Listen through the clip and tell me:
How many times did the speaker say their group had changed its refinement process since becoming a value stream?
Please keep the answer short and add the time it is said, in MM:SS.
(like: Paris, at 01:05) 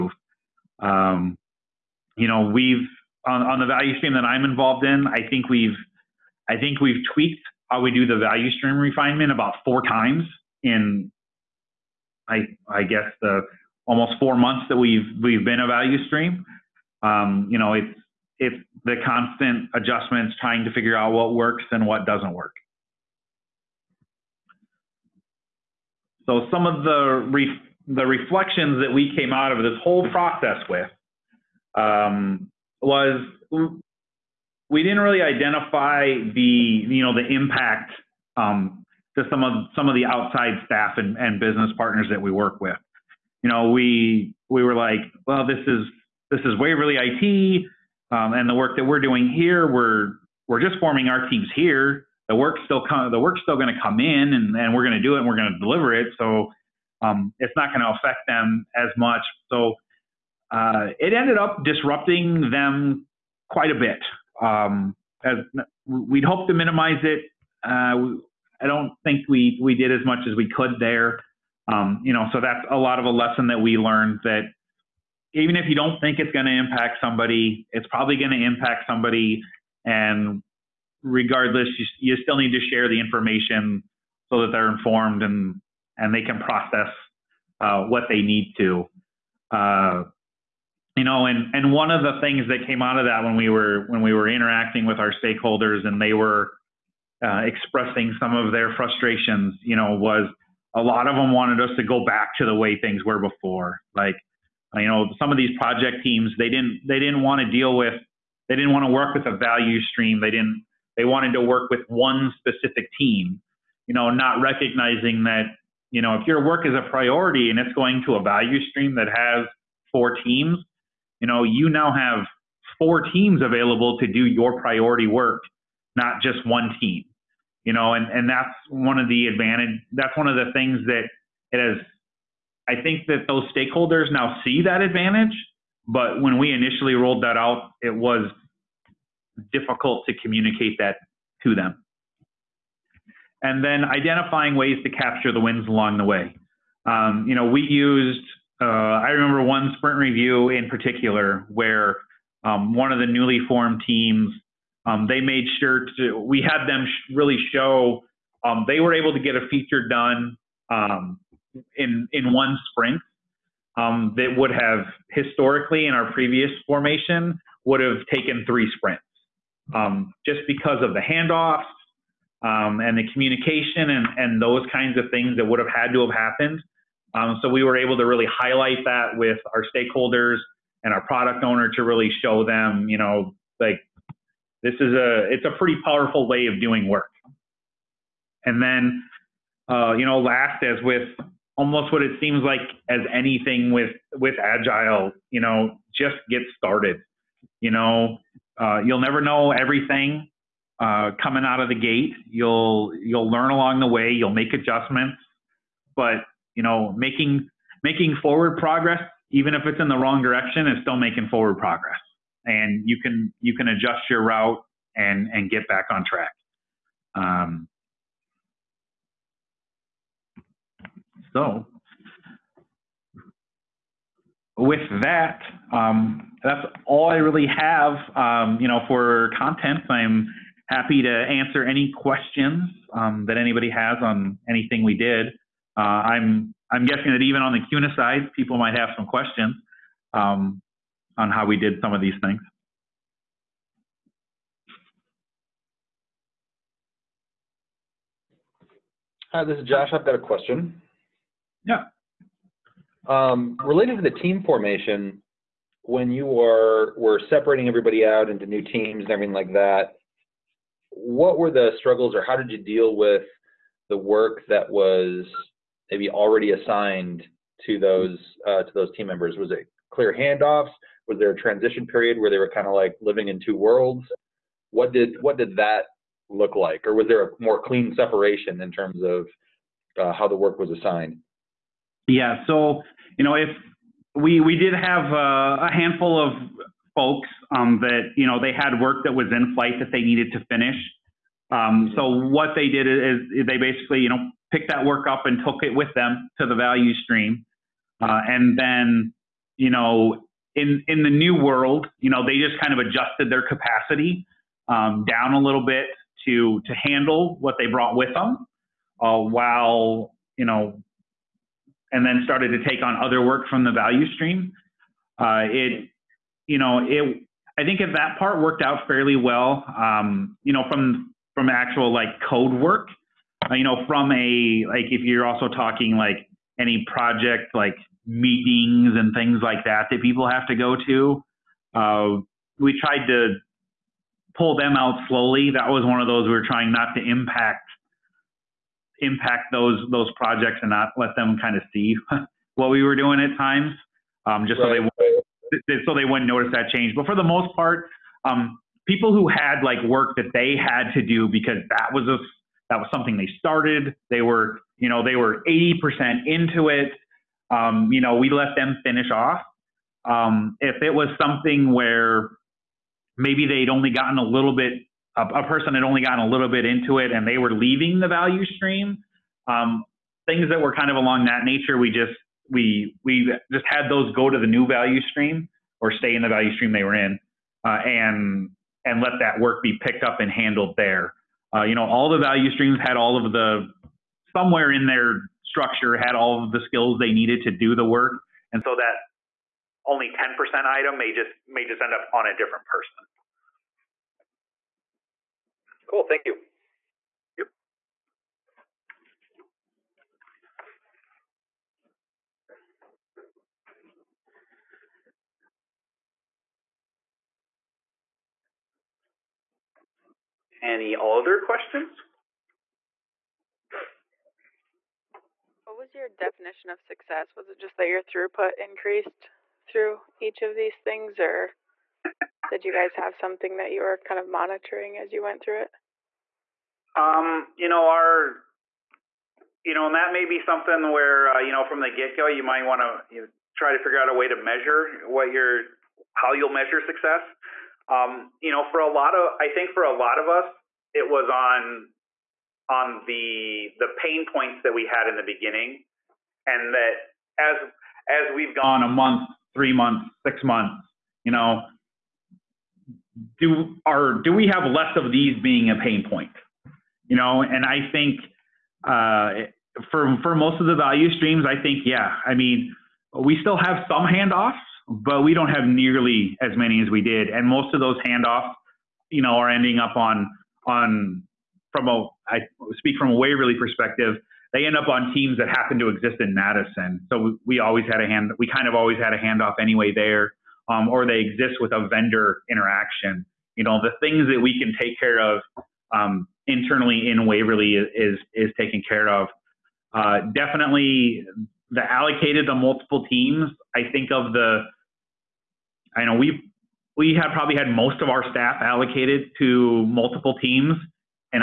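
4 times, at 00:09.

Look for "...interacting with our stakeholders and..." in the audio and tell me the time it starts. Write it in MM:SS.
01:34.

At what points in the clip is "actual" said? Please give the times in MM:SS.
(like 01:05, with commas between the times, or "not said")
05:21.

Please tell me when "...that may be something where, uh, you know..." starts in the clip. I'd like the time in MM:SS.
07:09.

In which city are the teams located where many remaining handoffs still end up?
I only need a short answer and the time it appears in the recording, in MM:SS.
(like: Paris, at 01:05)
Madison, at 07:56.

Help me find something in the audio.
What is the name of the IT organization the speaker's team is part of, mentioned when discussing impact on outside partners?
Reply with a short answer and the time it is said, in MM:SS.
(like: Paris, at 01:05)
Waverly IT, at 00:46.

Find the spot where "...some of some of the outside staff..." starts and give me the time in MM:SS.
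00:39.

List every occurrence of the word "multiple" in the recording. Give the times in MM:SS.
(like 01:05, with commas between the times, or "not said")
08:12, 08:19.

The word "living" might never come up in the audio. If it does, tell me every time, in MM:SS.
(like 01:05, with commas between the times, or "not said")
04:33.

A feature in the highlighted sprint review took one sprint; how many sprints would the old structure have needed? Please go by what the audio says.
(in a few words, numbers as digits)
3 sprints.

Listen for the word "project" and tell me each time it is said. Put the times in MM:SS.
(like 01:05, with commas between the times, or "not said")
01:45, 05:26, 05:40.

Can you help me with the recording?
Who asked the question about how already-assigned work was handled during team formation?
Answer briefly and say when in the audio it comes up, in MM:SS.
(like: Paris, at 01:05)
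Josh, at 04:09.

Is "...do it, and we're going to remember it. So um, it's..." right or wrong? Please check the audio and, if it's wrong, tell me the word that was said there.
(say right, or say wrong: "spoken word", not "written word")
wrong: "deliver", not "remember".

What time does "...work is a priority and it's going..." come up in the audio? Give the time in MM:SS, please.
01:56.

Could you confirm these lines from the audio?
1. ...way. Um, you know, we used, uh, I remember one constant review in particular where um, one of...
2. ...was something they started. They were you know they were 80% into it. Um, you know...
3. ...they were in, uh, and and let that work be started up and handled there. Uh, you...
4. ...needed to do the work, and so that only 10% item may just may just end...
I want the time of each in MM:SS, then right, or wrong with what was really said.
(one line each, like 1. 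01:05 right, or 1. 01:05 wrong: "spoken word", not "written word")
1. 02:26 wrong: "sprint", not "constant"
2. 05:52 right
3. 06:16 wrong: "picked", not "started"
4. 06:27 right.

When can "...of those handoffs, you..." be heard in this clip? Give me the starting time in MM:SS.
07:47.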